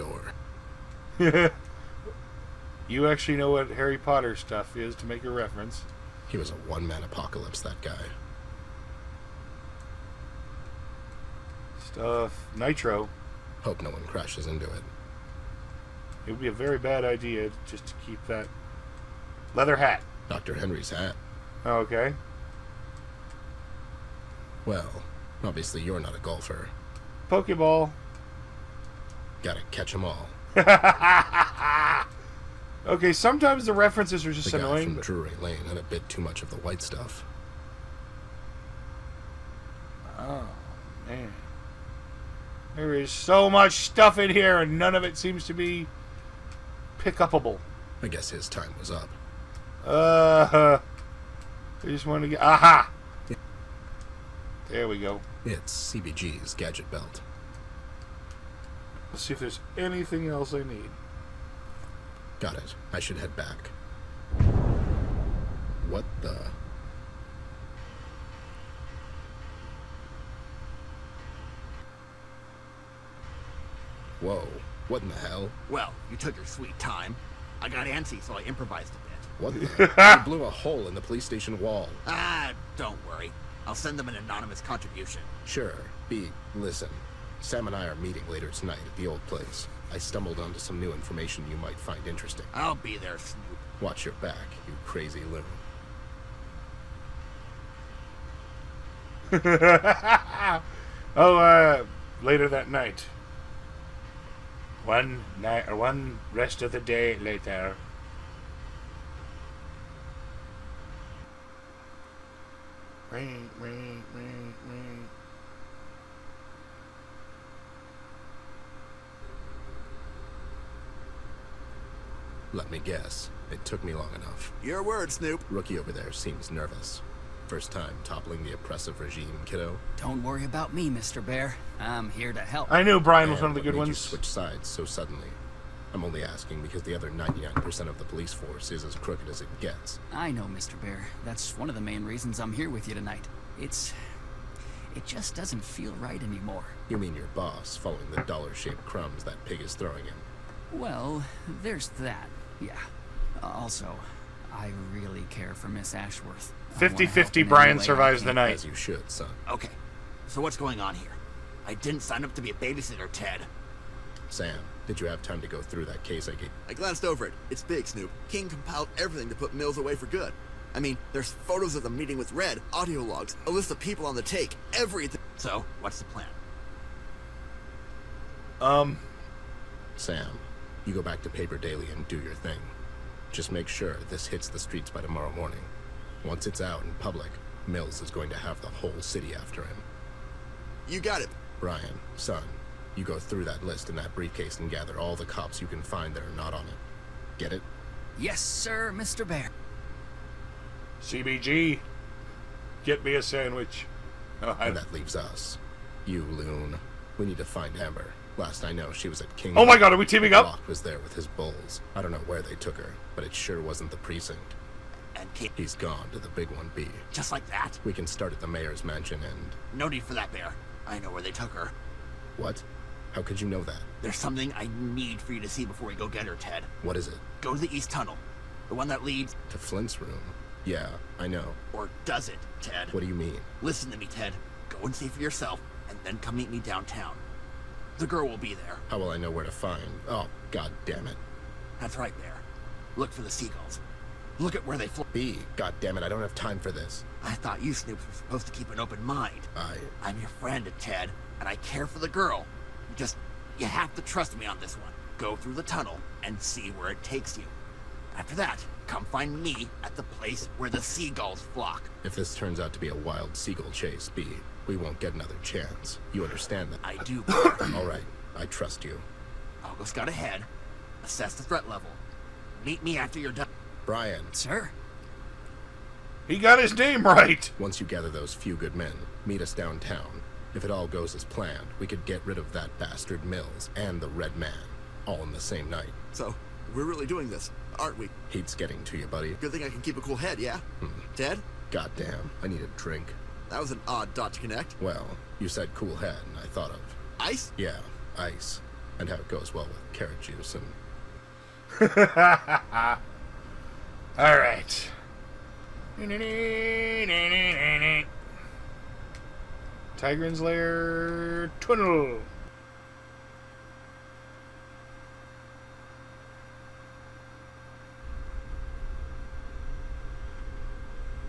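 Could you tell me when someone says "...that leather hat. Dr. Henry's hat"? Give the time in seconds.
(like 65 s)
18 s.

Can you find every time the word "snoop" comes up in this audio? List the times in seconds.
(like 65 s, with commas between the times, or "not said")
93 s, 125 s, 167 s, 247 s.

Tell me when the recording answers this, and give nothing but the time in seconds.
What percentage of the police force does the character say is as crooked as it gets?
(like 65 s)
137 s.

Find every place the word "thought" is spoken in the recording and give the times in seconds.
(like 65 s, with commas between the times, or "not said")
247 s, 296 s.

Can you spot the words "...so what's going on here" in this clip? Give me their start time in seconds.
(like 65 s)
160 s.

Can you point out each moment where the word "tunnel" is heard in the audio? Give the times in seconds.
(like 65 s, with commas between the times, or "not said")
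227 s, 255 s, 311 s.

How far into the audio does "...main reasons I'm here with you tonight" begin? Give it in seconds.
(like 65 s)
141 s.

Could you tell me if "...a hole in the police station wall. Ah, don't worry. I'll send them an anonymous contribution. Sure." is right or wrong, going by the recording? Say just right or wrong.
right.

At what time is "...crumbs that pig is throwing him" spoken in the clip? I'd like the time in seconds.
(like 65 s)
148 s.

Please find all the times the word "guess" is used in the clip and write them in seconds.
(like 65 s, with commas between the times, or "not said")
48 s, 122 s.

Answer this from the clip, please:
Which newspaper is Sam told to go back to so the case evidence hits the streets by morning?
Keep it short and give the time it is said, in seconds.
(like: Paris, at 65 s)
Paper Daily, at 181 s.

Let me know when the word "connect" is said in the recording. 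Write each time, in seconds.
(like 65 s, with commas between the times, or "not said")
294 s.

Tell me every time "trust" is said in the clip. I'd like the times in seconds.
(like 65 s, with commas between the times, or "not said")
254 s, 268 s.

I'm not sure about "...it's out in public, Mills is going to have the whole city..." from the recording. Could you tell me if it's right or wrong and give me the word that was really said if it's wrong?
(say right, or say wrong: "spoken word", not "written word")
right.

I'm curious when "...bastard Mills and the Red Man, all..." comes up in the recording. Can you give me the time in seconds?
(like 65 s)
282 s.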